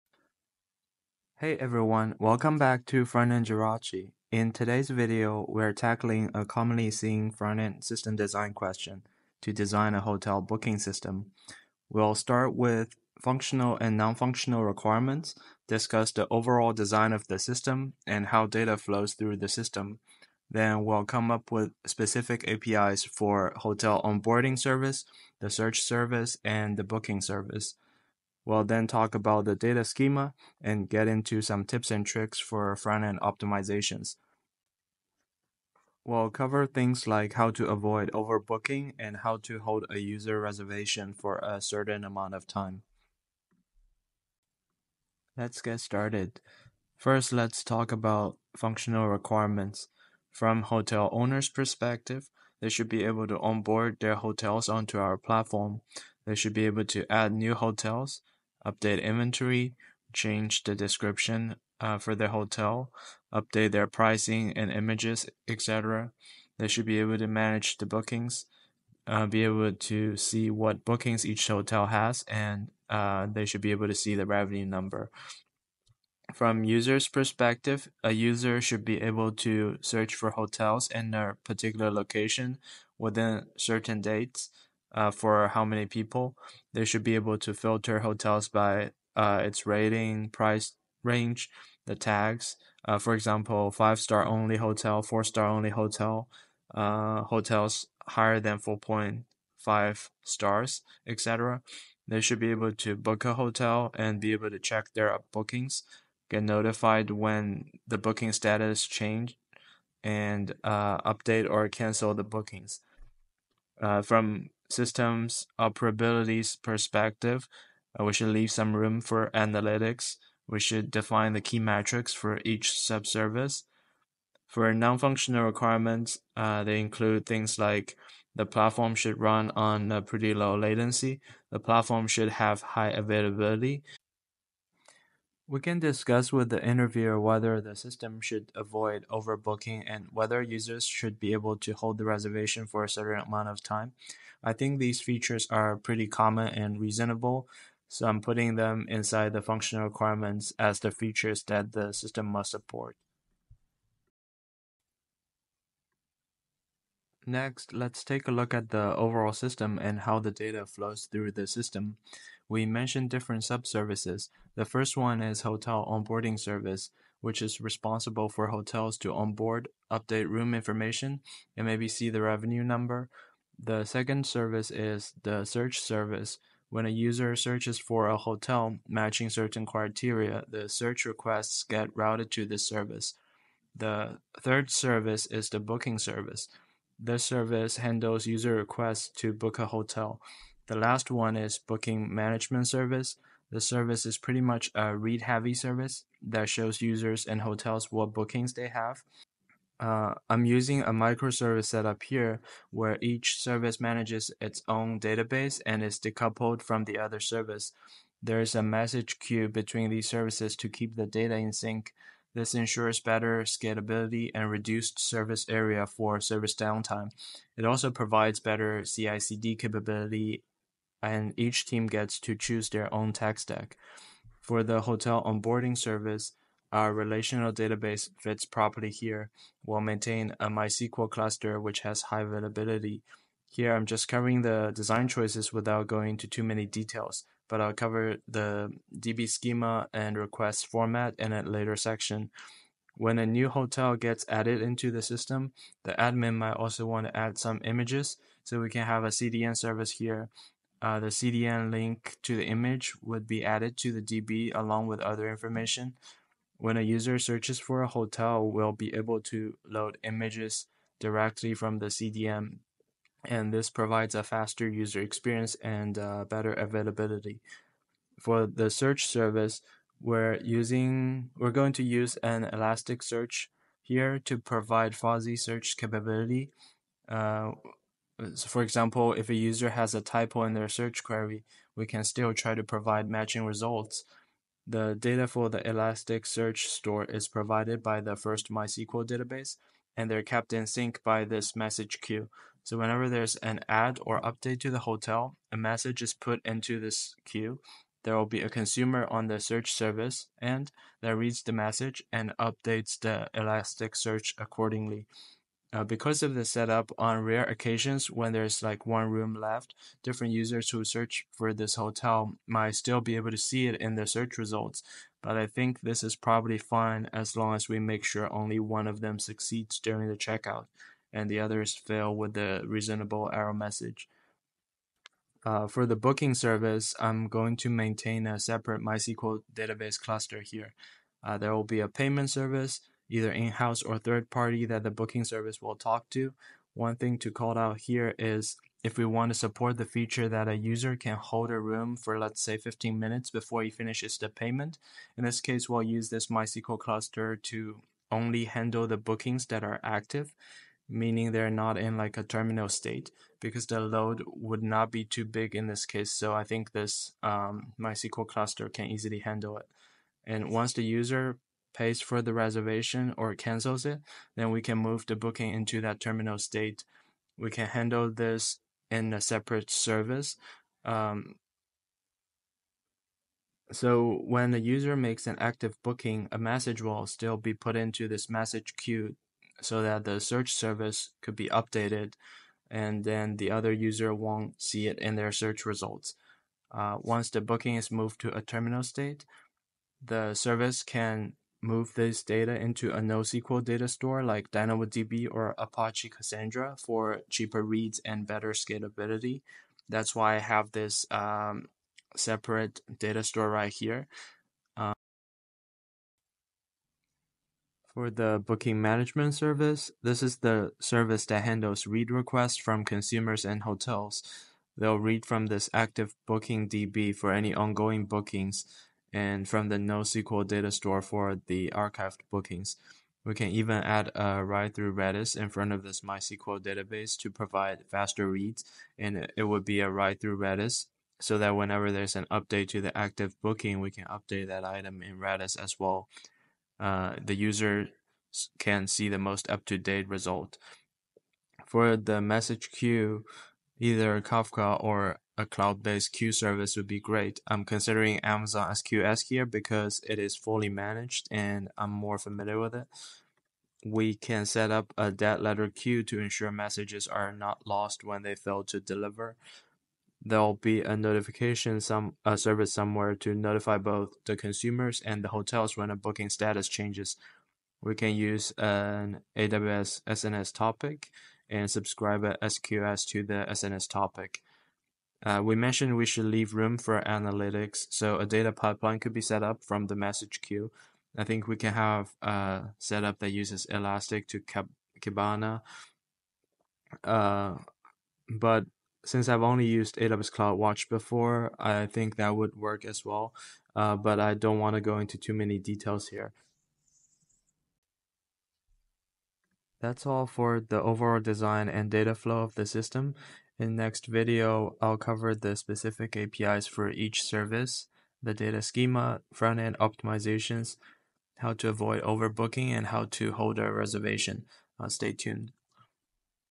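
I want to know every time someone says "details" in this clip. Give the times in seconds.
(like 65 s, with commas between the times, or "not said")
236 s, 495 s.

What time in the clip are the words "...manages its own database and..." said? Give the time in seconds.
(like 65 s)
203 s.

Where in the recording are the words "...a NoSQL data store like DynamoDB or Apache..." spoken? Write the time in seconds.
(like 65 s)
392 s.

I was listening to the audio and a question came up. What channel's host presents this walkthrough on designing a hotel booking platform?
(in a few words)
Front-end Jirachi.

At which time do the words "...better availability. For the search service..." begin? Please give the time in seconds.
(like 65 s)
266 s.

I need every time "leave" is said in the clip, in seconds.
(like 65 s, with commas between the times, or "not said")
118 s, 476 s.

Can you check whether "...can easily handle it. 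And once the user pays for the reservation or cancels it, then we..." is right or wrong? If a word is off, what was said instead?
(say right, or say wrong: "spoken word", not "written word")
right.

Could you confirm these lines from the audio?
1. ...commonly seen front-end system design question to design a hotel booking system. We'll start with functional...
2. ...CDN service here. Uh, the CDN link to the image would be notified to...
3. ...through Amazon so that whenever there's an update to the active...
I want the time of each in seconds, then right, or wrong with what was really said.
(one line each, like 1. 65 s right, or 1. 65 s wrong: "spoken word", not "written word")
1. 6 s right
2. 249 s wrong: "added", not "notified"
3. 430 s wrong: "Redis", not "Amazon".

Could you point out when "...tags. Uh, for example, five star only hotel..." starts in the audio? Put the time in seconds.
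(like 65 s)
91 s.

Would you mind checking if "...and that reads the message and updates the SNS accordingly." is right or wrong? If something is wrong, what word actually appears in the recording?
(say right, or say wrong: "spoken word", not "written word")
wrong: "Elasticsearch", not "SNS".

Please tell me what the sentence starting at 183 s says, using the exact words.
The third service is the booking service.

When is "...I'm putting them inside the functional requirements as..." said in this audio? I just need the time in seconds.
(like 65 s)
148 s.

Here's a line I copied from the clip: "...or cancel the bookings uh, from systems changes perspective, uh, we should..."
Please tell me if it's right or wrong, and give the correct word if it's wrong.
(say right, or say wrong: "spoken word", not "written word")
wrong: "operabilities", not "changes".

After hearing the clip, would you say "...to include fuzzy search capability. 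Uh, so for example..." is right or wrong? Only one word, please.
wrong.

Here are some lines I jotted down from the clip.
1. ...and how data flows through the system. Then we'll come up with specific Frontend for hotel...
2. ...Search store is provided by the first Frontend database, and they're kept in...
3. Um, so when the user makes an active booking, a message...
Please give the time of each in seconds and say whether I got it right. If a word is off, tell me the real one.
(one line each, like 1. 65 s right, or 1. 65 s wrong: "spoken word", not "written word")
1. 18 s wrong: "APIs", not "Frontend"
2. 286 s wrong: "MySQL", not "Frontend"
3. 370 s right.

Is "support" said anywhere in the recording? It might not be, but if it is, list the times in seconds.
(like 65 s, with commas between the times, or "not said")
152 s, 339 s.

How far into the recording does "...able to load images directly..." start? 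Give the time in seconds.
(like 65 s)
258 s.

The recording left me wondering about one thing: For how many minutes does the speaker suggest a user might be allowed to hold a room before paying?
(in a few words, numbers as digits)
15.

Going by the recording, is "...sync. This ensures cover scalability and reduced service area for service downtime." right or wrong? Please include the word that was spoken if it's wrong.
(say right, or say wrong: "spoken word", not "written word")
wrong: "better", not "cover".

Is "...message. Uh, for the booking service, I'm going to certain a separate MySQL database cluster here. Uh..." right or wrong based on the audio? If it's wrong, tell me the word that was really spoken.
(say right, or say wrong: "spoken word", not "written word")
wrong: "maintain", not "certain".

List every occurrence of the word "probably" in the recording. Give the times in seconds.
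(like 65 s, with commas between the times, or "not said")
316 s.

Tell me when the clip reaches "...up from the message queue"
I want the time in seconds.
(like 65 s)
479 s.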